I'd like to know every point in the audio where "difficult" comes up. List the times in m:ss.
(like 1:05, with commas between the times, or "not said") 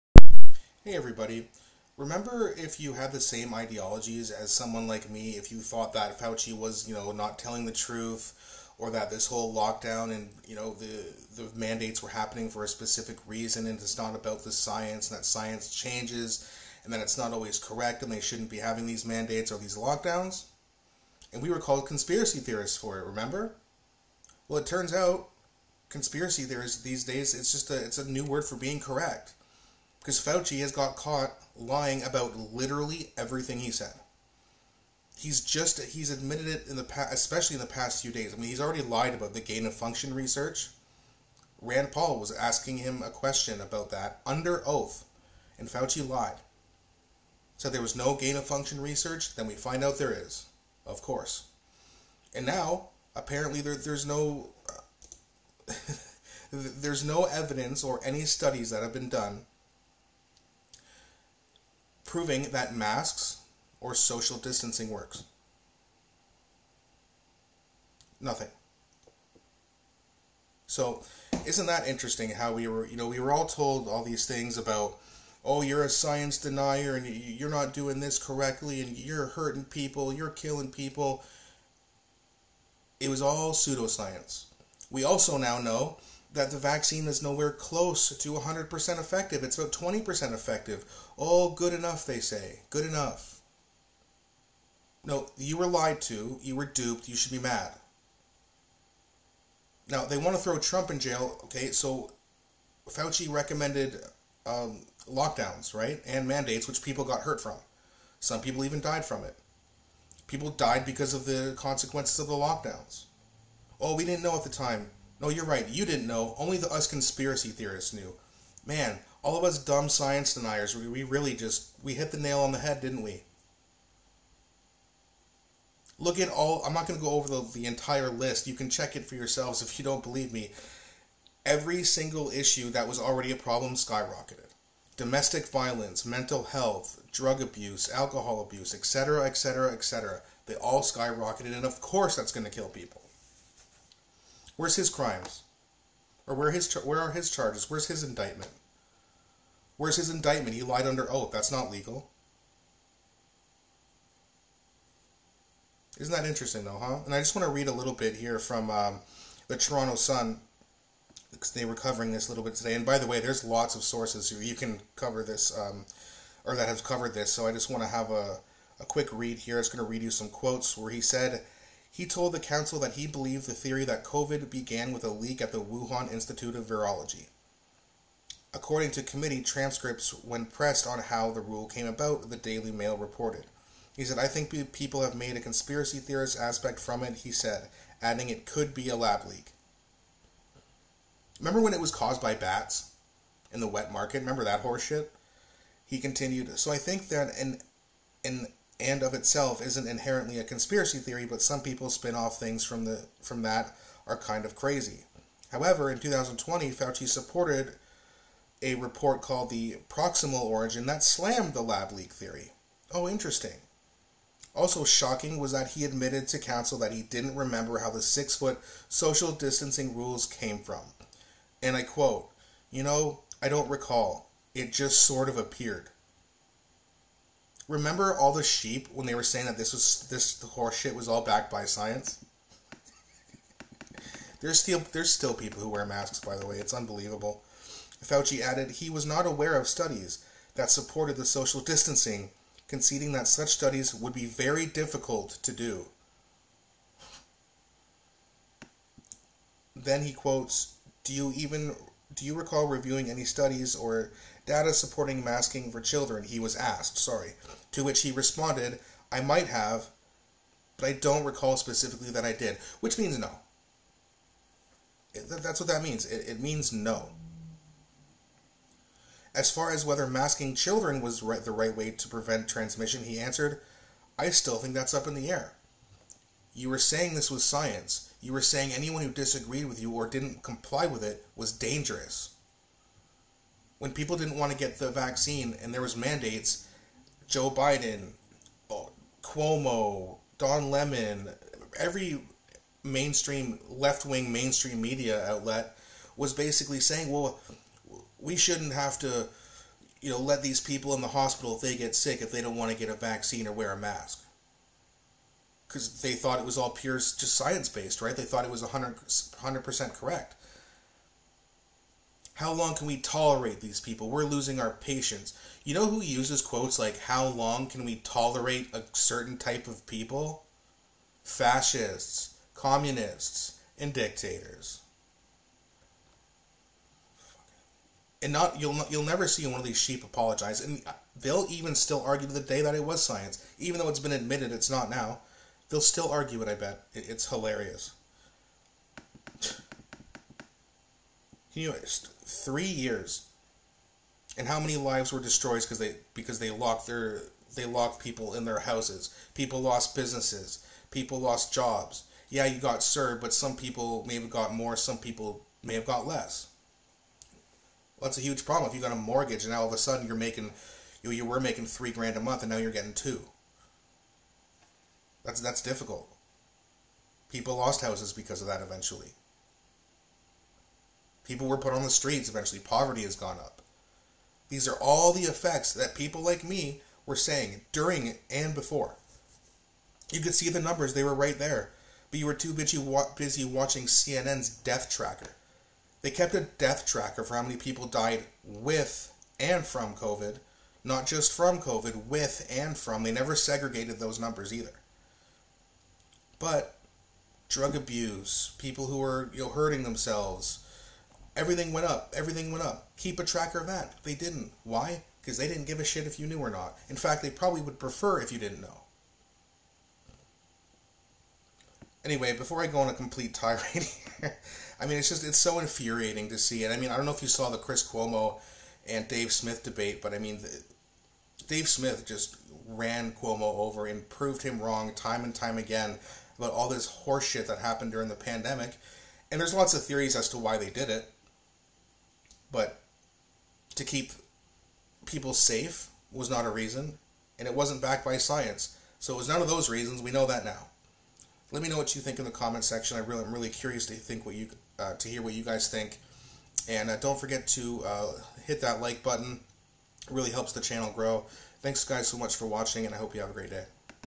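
4:04, 6:05.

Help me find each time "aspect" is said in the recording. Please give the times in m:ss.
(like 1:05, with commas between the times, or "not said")
3:06.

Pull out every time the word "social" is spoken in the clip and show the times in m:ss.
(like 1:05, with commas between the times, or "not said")
1:03, 3:38, 4:01.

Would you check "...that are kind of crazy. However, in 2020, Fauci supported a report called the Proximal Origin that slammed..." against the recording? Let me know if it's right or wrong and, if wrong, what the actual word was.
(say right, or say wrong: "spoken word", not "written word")
right.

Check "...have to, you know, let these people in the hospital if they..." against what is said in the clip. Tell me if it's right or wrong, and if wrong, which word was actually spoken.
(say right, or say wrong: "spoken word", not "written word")
right.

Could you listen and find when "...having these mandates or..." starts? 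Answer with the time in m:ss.
0:18.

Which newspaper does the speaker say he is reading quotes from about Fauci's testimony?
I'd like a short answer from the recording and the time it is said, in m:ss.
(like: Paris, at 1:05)
Toronto Sun, at 2:39.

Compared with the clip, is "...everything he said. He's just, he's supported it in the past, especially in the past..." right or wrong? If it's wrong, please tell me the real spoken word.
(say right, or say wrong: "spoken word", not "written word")
wrong: "admitted", not "supported".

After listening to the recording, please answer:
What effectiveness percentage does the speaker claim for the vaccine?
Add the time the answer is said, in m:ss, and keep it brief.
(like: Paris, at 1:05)
20%, at 1:29.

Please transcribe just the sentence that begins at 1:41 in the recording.
Okay, so Fauci recommended um, lockdowns, right?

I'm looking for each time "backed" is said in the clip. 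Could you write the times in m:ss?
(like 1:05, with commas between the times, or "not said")
3:51, 7:17.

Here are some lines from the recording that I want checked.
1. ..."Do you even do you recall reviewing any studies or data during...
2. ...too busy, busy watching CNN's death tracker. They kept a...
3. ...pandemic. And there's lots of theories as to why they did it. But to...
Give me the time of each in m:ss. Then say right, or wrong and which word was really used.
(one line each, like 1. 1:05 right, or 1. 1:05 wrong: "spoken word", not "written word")
1. 4:11 wrong: "supporting", not "during"
2. 6:22 right
3. 7:08 right.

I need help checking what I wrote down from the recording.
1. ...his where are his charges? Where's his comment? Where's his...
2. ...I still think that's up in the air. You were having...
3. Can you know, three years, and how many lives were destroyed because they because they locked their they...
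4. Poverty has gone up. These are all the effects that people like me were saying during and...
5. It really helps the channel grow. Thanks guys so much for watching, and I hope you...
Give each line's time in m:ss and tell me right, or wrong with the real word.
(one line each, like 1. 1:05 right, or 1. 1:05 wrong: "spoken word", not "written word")
1. 2:26 wrong: "indictment", not "comment"
2. 4:34 wrong: "saying", not "having"
3. 5:41 right
4. 6:12 right
5. 7:30 right.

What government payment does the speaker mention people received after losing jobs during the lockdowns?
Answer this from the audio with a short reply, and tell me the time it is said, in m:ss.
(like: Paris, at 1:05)
CERB, at 5:52.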